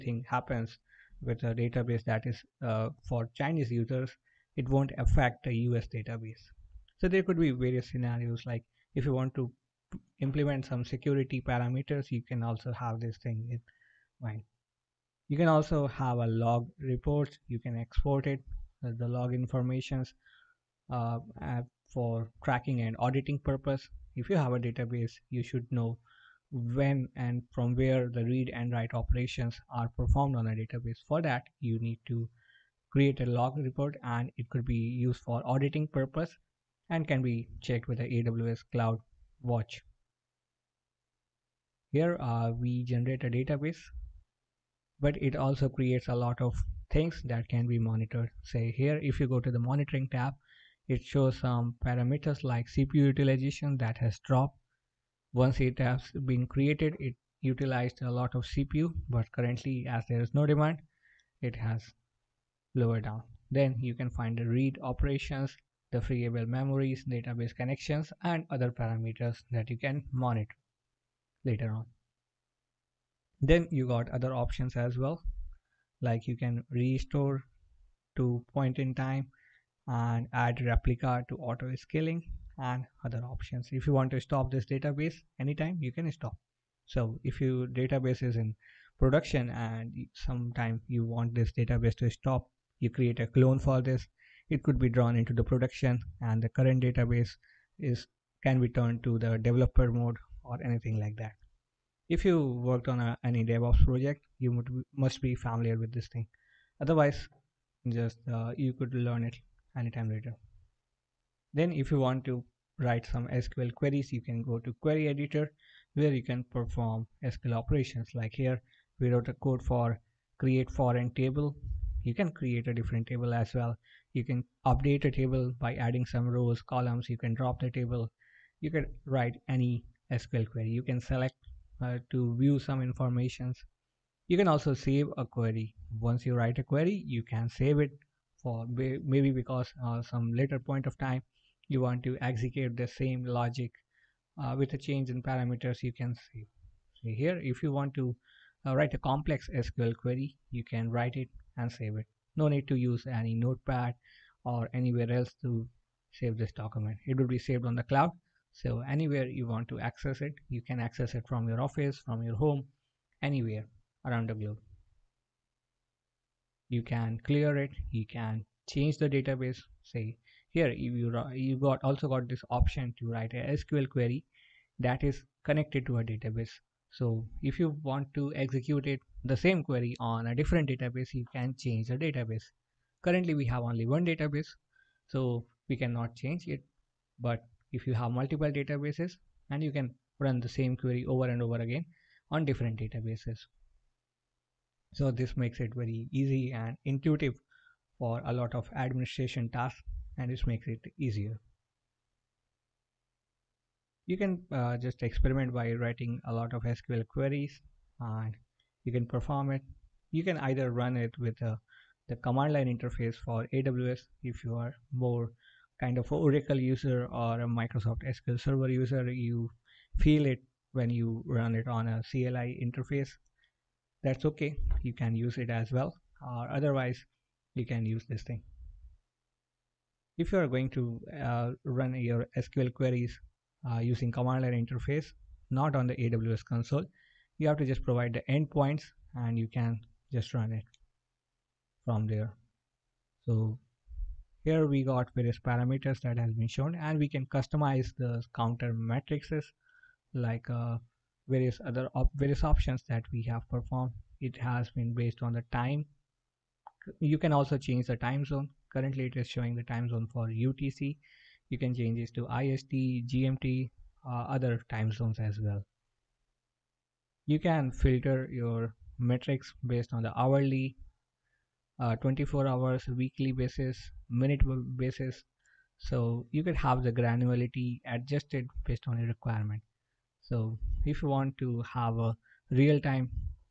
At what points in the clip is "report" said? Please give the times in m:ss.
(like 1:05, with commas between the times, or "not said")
0:16, 0:33.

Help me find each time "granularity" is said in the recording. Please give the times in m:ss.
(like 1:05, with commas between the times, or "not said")
4:36.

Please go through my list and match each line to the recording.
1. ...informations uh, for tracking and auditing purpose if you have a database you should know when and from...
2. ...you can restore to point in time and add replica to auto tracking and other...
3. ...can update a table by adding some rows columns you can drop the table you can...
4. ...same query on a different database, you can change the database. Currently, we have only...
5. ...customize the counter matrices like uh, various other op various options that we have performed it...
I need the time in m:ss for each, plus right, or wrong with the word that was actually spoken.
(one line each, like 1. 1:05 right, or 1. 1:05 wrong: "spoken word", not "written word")
1. 0:19 right
2. 1:16 wrong: "scaling", not "tracking"
3. 2:04 right
4. 2:59 right
5. 4:07 right.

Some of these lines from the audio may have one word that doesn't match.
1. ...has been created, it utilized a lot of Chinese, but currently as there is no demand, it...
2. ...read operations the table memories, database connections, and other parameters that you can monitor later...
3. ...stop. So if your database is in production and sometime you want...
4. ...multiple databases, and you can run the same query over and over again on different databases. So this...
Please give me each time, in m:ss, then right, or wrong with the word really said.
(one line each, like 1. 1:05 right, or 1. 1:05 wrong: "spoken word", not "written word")
1. 0:55 wrong: "CPU", not "Chinese"
2. 1:04 wrong: "freeable", not "table"
3. 1:26 right
4. 3:08 right.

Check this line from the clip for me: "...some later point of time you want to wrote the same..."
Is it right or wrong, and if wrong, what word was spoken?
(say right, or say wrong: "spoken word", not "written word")
wrong: "execute", not "wrote".